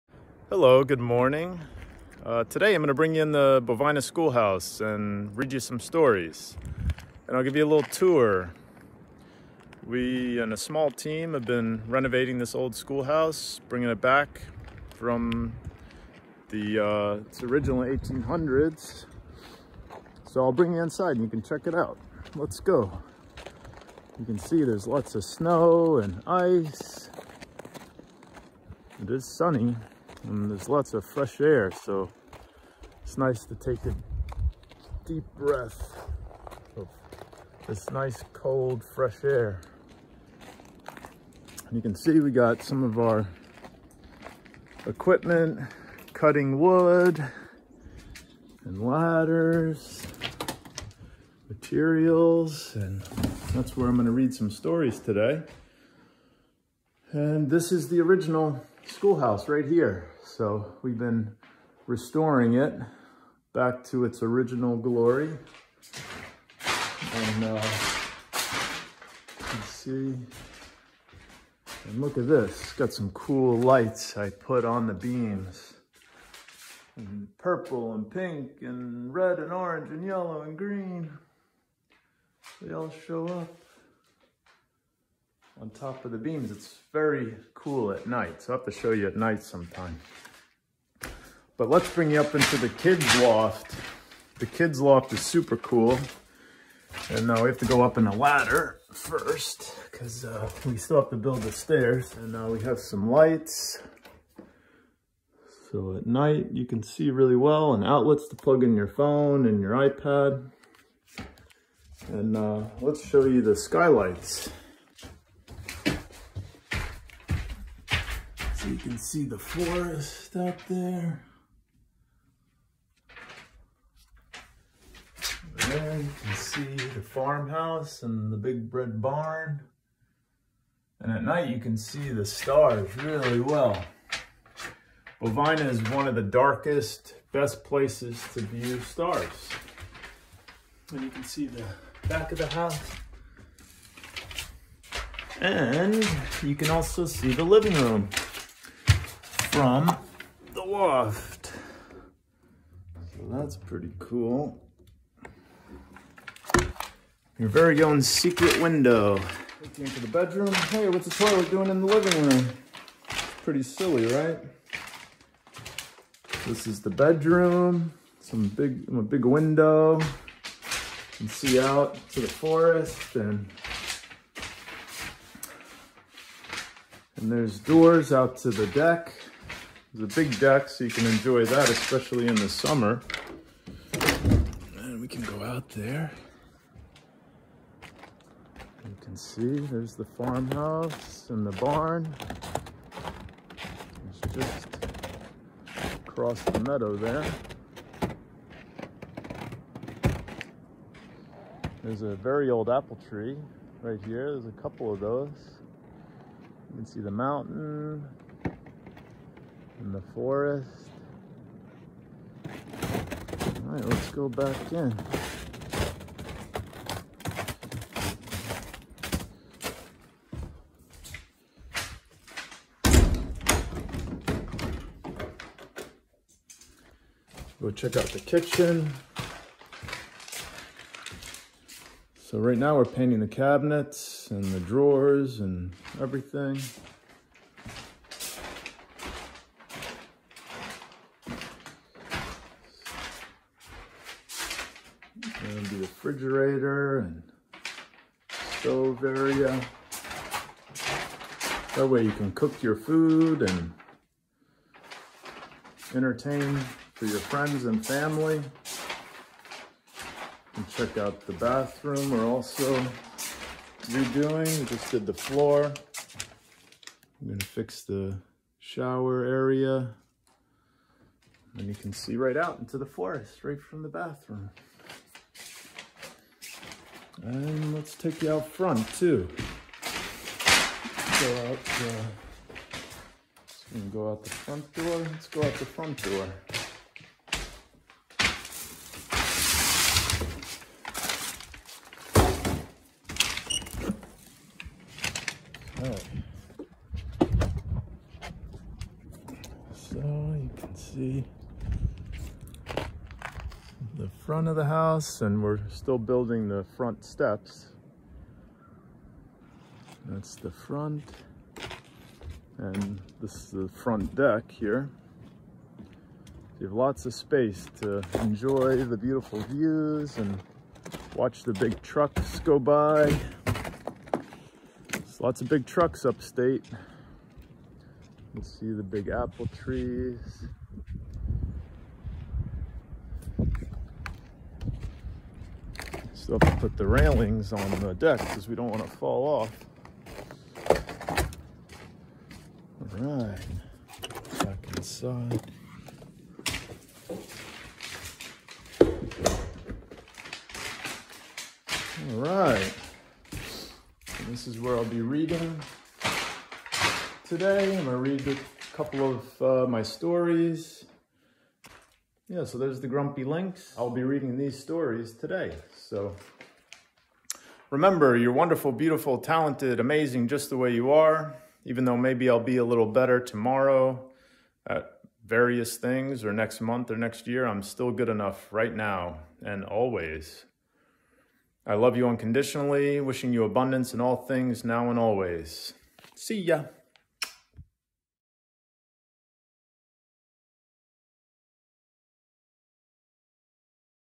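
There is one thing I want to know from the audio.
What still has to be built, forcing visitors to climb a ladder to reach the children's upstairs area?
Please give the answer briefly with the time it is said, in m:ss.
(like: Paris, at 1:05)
The stairs, at 1:41.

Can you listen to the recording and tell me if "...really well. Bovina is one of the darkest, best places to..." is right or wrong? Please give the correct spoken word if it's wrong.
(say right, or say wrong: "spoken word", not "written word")
right.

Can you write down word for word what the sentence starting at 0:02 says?
Uh, today I'm going to bring you in the Bovina Schoolhouse and read you some stories.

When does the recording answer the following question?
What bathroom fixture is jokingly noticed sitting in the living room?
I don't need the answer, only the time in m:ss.
2:41.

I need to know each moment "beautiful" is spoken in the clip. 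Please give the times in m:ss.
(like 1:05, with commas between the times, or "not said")
5:18, 6:08.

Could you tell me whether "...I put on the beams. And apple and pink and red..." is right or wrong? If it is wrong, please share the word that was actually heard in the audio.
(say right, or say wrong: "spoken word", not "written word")
wrong: "purple", not "apple".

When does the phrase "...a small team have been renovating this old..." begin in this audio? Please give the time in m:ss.
0:10.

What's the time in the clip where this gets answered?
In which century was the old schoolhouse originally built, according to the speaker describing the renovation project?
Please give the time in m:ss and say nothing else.
0:17.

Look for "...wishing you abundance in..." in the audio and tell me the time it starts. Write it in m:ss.
6:23.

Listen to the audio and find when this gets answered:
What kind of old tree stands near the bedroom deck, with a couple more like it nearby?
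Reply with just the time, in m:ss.
3:22.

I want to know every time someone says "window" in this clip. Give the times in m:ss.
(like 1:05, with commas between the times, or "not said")
2:38, 2:49.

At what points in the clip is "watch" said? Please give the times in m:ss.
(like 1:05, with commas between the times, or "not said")
5:21.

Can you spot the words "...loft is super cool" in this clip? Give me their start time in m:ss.
1:34.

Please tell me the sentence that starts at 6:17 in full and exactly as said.
I'm still good enough right now and always.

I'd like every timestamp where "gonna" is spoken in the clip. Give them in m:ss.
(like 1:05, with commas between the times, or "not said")
0:53, 4:27, 5:57.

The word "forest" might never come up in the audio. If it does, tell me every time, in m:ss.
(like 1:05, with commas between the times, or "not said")
1:59, 2:52, 3:30, 4:32.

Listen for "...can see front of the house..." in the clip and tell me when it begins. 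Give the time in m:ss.
5:00.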